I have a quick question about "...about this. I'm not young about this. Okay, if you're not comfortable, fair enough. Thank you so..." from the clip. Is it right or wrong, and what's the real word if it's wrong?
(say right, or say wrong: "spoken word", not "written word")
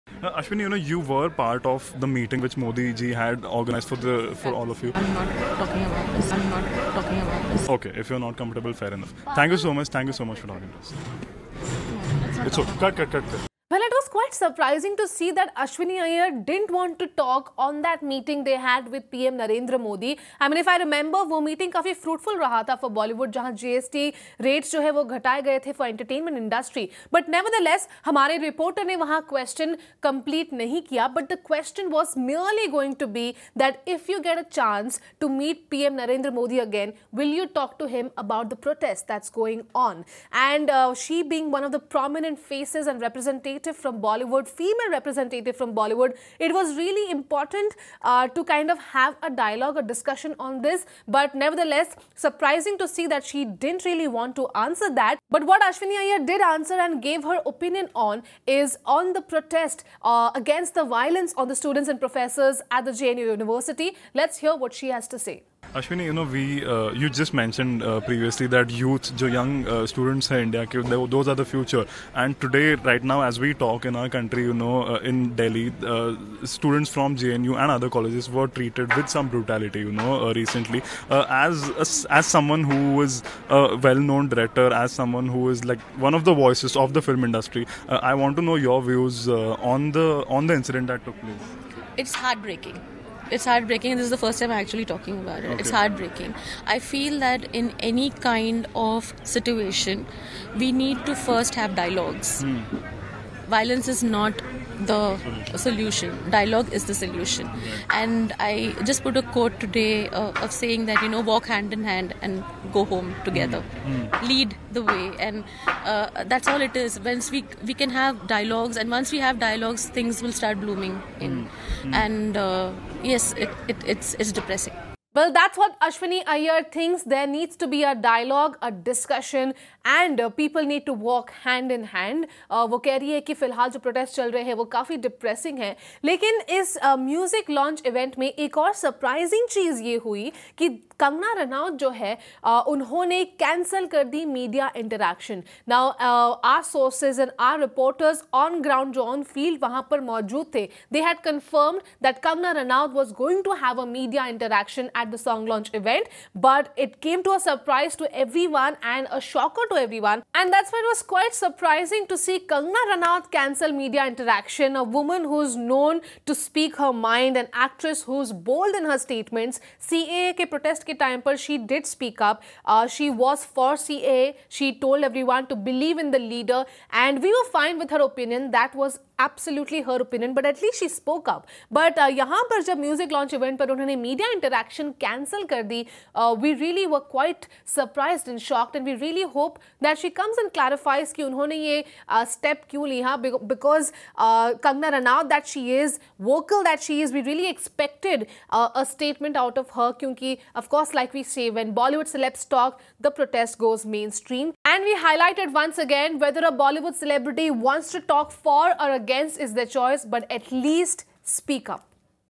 wrong: "talking", not "young".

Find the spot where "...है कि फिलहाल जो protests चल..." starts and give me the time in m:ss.
2:13.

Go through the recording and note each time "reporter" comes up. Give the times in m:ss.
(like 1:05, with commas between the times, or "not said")
0:28, 2:27.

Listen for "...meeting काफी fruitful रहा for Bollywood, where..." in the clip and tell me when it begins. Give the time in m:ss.
0:21.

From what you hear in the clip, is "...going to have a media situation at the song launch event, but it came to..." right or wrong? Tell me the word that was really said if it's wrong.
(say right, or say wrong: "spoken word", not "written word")
wrong: "interaction", not "situation".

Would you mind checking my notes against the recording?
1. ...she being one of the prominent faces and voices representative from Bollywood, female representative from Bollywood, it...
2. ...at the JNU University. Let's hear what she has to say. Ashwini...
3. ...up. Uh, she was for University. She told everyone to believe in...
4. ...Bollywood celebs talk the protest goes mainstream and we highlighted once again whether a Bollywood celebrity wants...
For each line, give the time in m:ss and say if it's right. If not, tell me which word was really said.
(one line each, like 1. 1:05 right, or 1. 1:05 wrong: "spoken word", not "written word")
1. 0:40 wrong: "representatives", not "voices"
2. 1:02 right
3. 2:52 wrong: "CAA", not "University"
4. 3:21 right.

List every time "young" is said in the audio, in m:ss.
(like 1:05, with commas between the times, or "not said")
1:09.